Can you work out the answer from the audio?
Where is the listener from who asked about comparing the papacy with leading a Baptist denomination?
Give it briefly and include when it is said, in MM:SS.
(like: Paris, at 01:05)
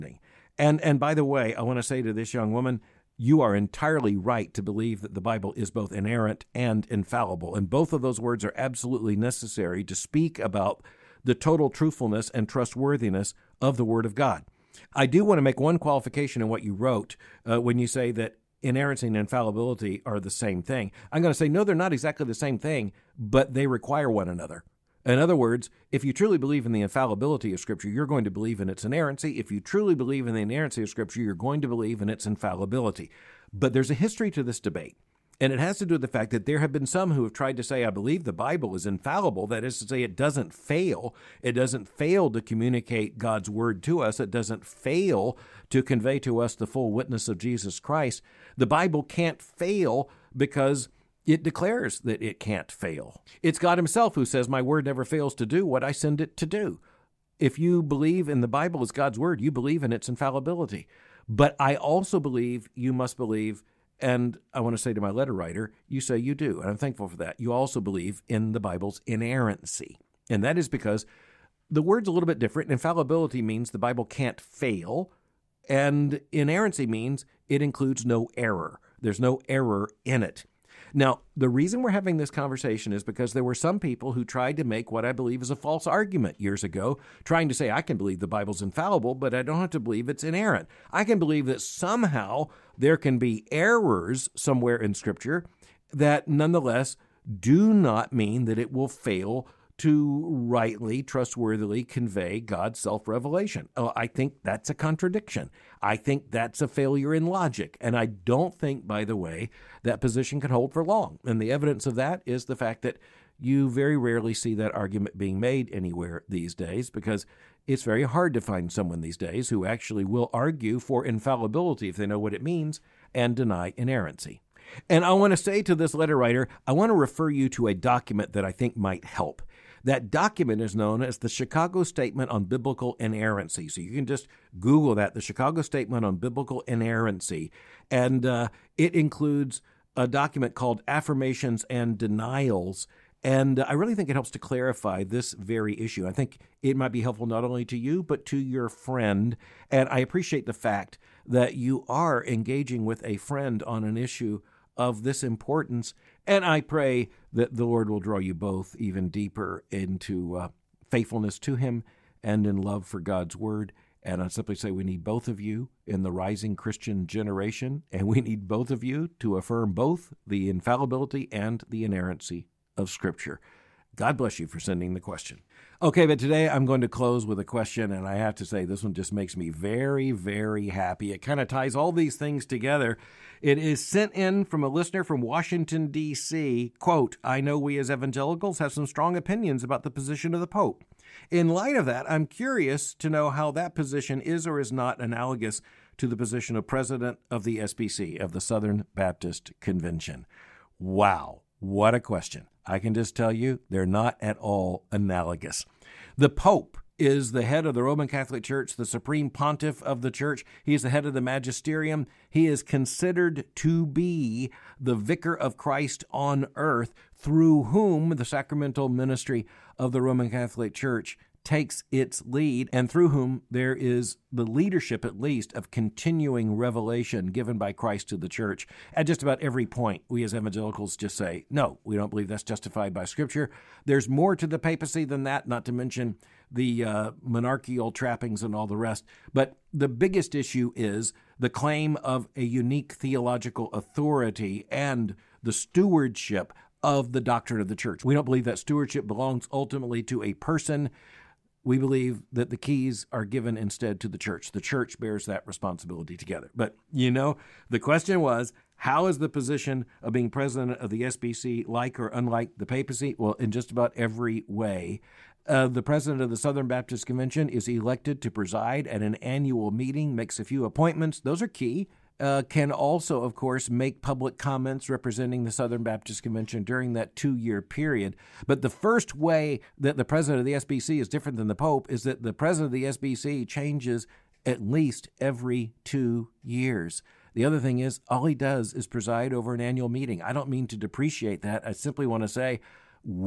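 Washington, D.C., at 03:05.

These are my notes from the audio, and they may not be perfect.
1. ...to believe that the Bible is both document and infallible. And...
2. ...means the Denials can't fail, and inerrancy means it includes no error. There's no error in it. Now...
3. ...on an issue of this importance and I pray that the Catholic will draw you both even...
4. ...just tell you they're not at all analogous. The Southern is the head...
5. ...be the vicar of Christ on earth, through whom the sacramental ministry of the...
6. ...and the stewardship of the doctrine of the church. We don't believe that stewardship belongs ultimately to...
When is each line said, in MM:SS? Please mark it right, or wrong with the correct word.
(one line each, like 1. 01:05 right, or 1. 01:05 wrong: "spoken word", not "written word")
1. 00:04 wrong: "inerrant", not "document"
2. 01:13 wrong: "Bible", not "Denials"
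3. 02:33 wrong: "Lord", not "Catholic"
4. 03:22 wrong: "Pope", not "Southern"
5. 03:33 right
6. 04:04 right.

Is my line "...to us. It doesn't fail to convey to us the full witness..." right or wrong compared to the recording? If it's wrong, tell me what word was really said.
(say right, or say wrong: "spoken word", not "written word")
right.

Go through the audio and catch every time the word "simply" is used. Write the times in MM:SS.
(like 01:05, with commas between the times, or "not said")
02:44, 04:51.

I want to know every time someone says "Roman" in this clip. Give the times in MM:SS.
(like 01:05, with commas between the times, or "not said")
03:27, 03:40.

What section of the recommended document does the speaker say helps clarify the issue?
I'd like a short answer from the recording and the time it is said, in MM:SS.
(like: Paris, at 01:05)
Affirmations and Denials, at 02:20.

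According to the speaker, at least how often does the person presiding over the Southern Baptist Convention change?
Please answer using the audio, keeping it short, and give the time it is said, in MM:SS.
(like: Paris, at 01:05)
every 2 years, at 04:45.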